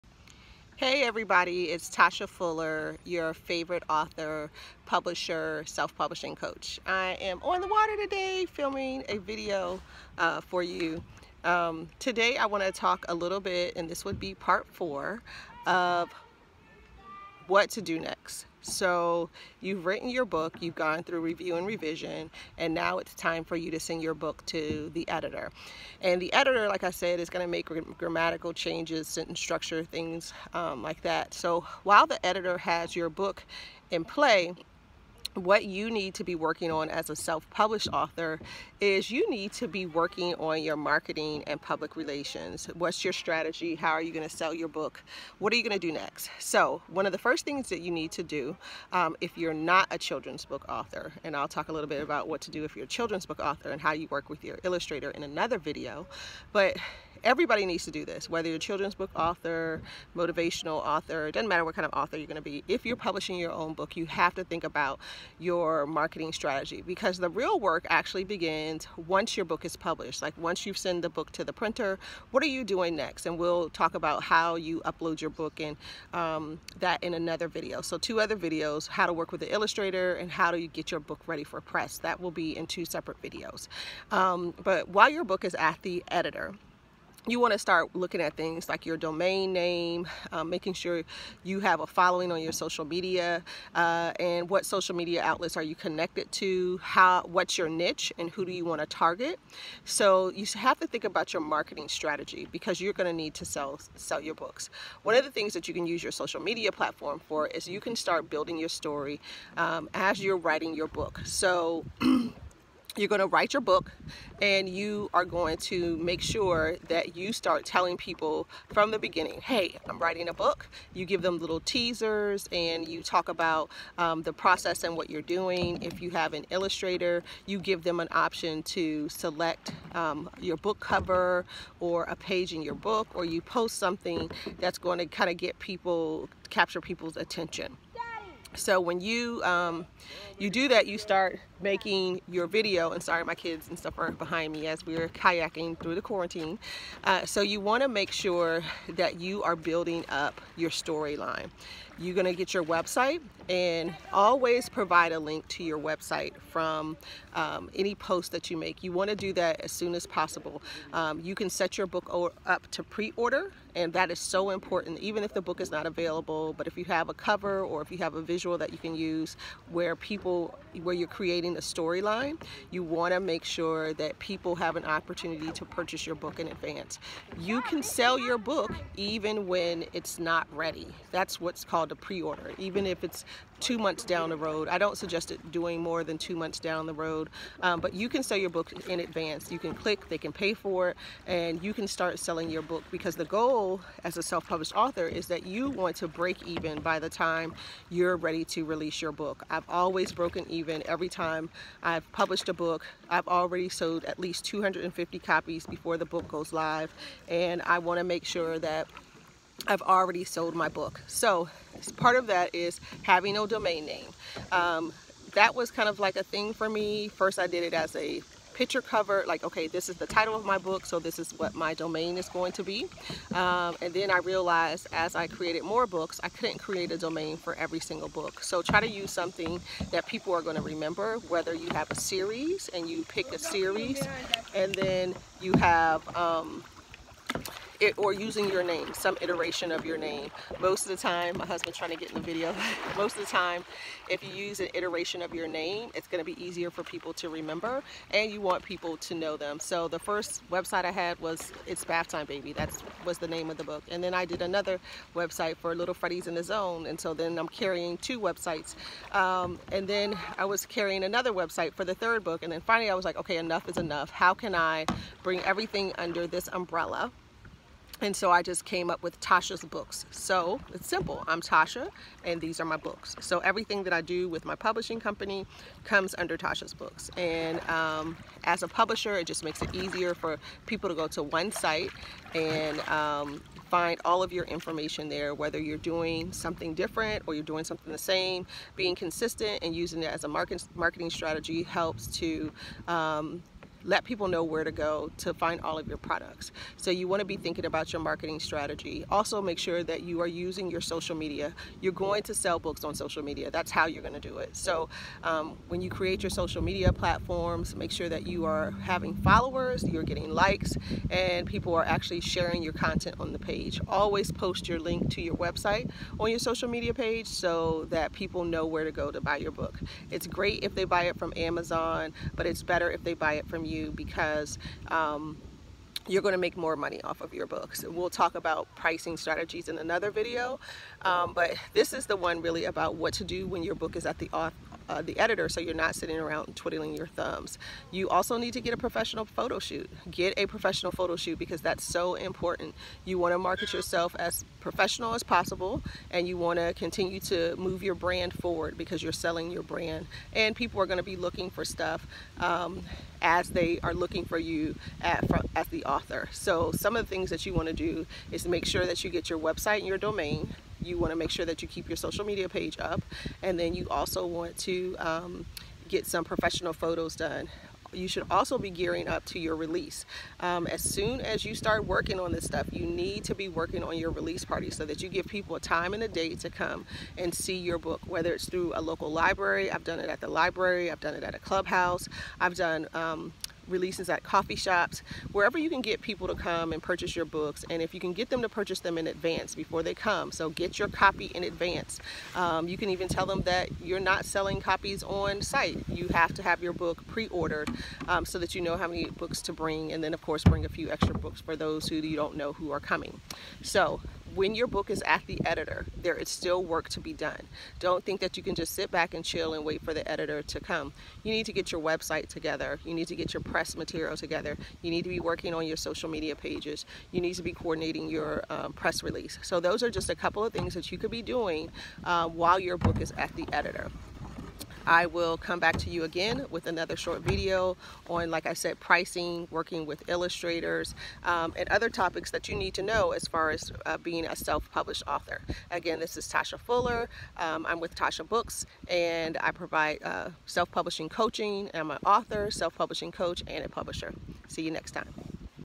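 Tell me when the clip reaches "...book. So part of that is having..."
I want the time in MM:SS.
03:30.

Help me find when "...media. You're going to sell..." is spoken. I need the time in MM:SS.
05:01.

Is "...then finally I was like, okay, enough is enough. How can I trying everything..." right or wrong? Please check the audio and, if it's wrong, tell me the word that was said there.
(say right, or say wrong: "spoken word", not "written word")
wrong: "bring", not "trying".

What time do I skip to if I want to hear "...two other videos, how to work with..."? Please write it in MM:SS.
01:17.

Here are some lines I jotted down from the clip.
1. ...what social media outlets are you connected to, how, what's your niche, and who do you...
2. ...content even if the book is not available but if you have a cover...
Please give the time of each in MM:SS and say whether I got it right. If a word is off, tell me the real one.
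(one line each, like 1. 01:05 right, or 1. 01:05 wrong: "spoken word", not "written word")
1. 01:34 right
2. 02:44 wrong: "important", not "content".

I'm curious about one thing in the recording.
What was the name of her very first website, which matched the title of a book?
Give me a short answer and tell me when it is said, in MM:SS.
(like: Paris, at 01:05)
It's Bath Time Baby, at 04:11.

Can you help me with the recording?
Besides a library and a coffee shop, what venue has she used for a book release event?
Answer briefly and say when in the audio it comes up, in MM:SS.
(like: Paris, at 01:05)
a clubhouse, at 06:21.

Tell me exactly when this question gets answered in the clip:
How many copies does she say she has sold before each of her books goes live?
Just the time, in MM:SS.
03:24.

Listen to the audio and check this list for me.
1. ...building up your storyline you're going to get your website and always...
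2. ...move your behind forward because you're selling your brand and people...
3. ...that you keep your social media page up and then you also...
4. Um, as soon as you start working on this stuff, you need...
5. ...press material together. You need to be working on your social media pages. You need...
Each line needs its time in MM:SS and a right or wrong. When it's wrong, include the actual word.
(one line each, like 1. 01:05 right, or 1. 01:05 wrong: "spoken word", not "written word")
1. 02:29 right
2. 05:47 wrong: "brand", not "behind"
3. 06:01 right
4. 06:10 right
5. 06:53 right.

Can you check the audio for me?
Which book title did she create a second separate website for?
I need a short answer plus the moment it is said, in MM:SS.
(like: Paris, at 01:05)
Little Freddy's in the Zone, at 04:15.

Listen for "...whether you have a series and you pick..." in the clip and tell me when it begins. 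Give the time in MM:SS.
03:51.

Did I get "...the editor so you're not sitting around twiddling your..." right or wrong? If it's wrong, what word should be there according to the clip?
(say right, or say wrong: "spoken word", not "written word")
right.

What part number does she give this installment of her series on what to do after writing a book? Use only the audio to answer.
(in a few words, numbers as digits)
4.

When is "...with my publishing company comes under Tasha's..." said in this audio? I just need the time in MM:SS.
04:34.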